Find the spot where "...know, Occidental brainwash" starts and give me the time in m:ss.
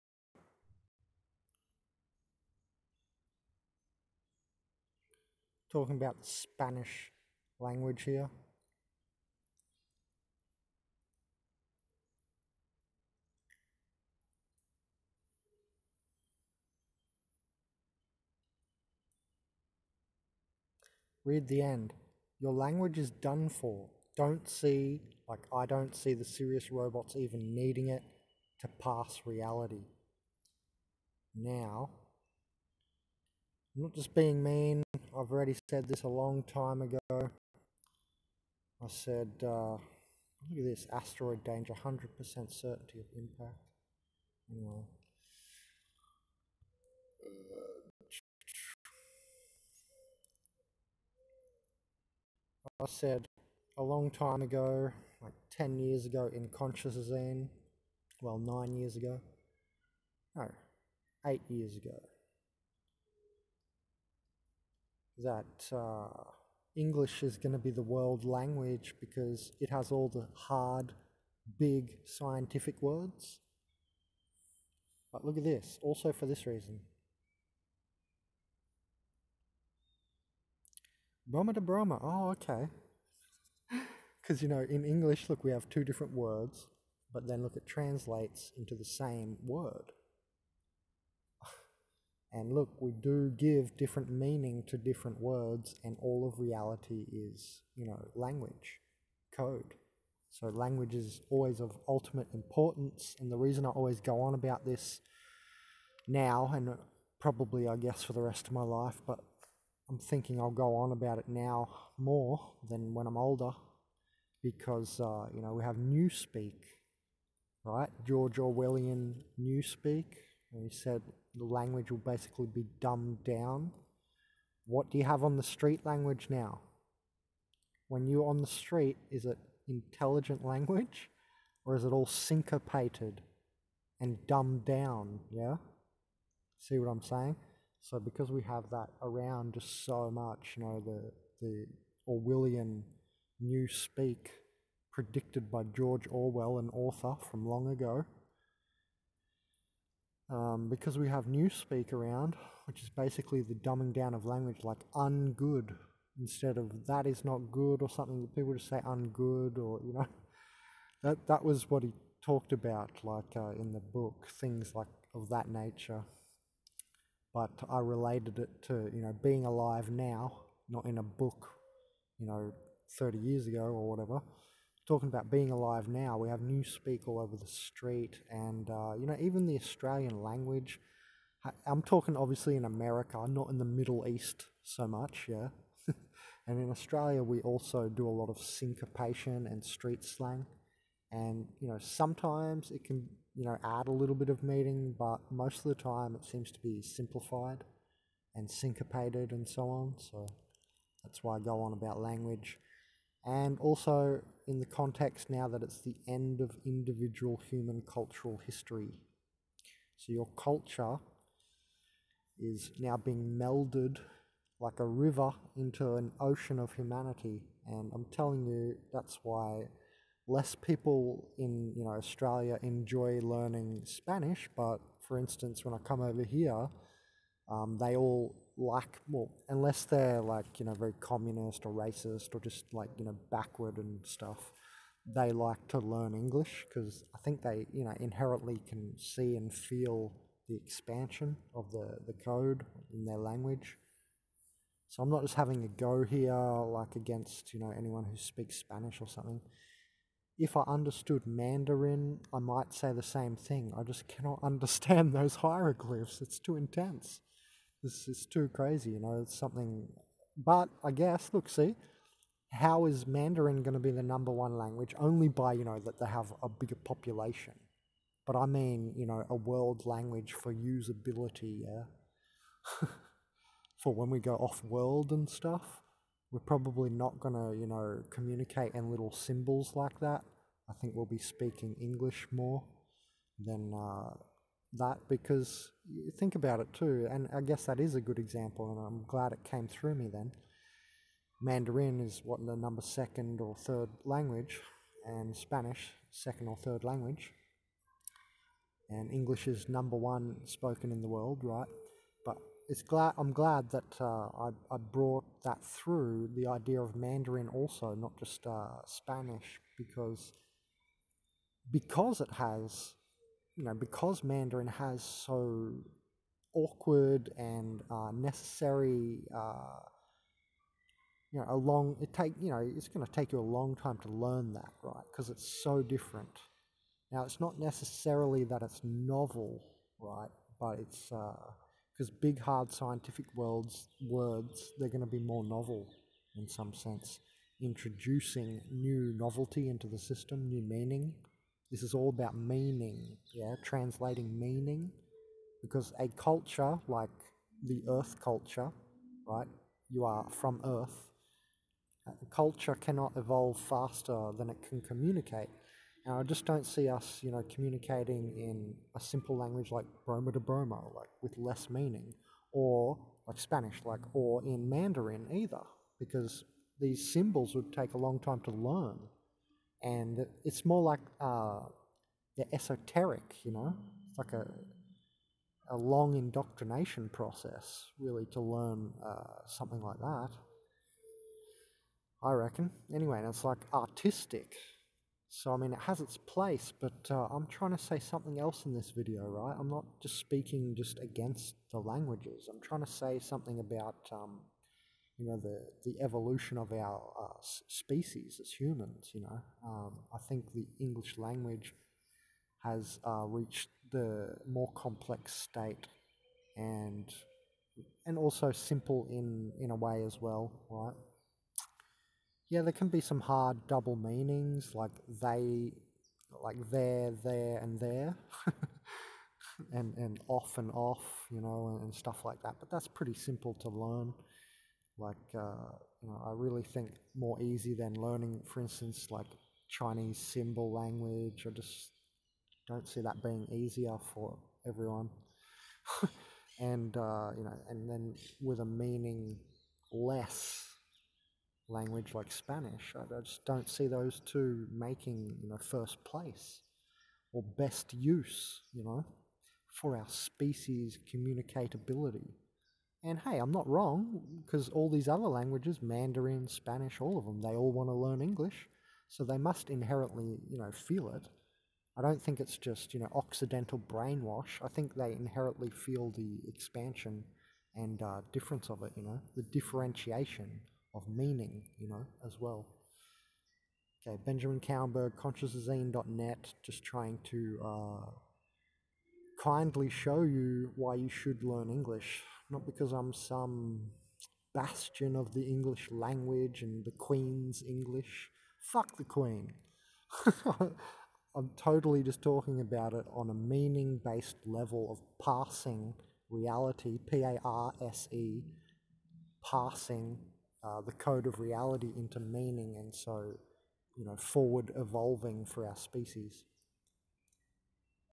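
7:42.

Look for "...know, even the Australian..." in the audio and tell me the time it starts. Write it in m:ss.
2:59.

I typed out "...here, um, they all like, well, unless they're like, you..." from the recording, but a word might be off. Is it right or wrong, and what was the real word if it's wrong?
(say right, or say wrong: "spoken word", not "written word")
right.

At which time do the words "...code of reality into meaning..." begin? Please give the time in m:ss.
8:20.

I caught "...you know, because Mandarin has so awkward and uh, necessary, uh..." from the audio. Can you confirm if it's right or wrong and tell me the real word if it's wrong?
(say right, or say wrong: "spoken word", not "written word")
right.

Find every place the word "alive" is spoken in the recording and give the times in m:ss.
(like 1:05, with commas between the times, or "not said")
2:49, 2:55.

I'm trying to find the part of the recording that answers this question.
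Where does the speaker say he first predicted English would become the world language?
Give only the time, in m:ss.
0:56.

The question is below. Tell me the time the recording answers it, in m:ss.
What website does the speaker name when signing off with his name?
7:55.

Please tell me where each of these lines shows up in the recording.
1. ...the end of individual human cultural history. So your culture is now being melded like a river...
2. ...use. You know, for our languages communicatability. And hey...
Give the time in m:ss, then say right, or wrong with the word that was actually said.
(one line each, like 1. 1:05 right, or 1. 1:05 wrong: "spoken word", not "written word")
1. 3:25 right
2. 7:27 wrong: "species", not "languages".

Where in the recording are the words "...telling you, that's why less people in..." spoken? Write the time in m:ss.
3:38.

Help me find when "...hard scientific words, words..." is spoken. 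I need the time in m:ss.
5:32.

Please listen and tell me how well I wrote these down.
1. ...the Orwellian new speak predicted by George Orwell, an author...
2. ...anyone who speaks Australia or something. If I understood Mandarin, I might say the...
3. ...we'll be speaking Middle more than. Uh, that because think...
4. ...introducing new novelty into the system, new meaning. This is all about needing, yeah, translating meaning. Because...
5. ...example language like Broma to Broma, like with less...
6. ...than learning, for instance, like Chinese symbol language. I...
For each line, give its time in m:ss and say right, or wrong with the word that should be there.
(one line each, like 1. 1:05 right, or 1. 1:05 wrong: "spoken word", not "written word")
1. 2:21 right
2. 4:07 wrong: "Spanish", not "Australia"
3. 4:40 wrong: "English", not "Middle"
4. 5:37 wrong: "meaning", not "needing"
5. 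5:58 wrong: "simple", not "example"
6. 7:07 right.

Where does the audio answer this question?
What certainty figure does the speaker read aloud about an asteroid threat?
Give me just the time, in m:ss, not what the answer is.
0:41.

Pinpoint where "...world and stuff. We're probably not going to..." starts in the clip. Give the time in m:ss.
4:34.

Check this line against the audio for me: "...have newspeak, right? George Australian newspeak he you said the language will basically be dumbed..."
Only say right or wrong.
wrong.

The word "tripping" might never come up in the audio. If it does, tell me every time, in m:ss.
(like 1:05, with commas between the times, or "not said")
not said.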